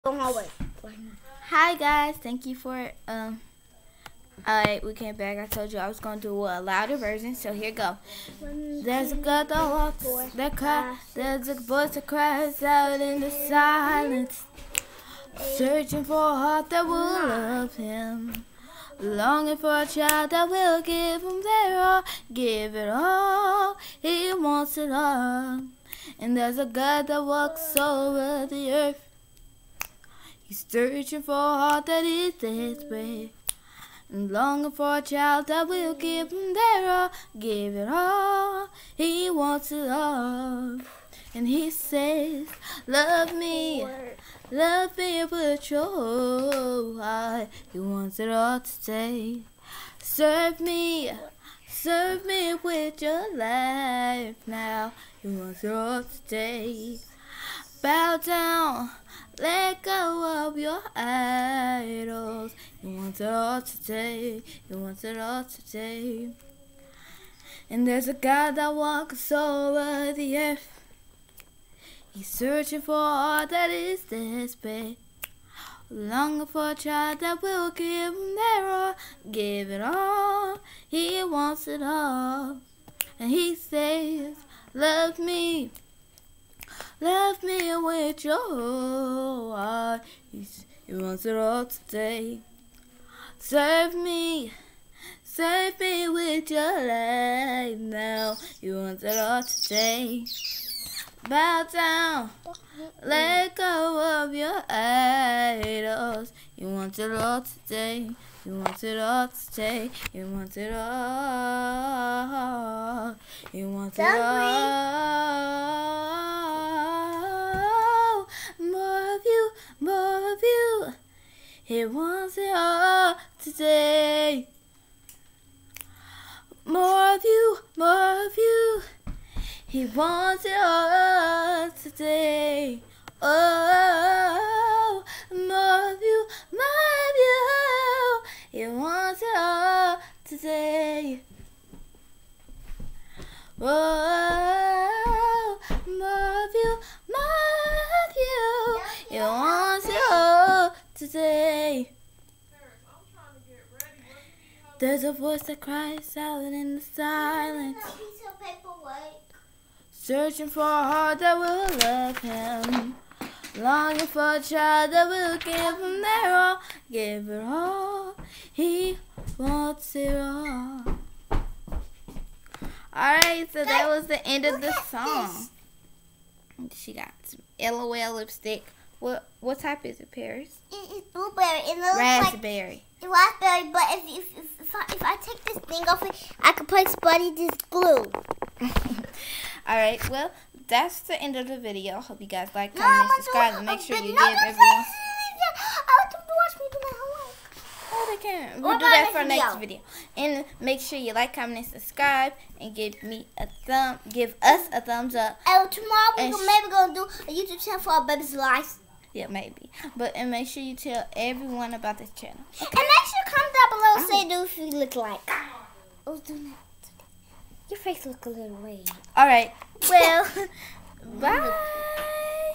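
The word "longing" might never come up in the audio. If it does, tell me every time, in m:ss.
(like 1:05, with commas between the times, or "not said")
0:18, 0:34, 1:15, 2:43.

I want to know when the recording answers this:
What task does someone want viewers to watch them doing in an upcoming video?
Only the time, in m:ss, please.
3:17.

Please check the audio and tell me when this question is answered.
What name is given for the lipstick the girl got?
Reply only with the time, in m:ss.
2:57.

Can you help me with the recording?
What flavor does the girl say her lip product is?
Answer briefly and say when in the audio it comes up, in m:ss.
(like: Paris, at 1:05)
Blueberry, at 3:01.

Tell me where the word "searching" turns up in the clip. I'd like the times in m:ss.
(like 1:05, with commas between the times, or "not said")
0:15, 0:30, 1:12, 2:39.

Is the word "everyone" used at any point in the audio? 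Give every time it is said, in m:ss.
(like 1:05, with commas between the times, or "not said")
3:14, 3:31.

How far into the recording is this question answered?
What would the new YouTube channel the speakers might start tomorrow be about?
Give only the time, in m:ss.
3:27.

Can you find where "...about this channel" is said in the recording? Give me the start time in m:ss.
3:31.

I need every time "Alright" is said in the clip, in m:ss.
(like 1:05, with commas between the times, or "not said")
0:04, 2:52.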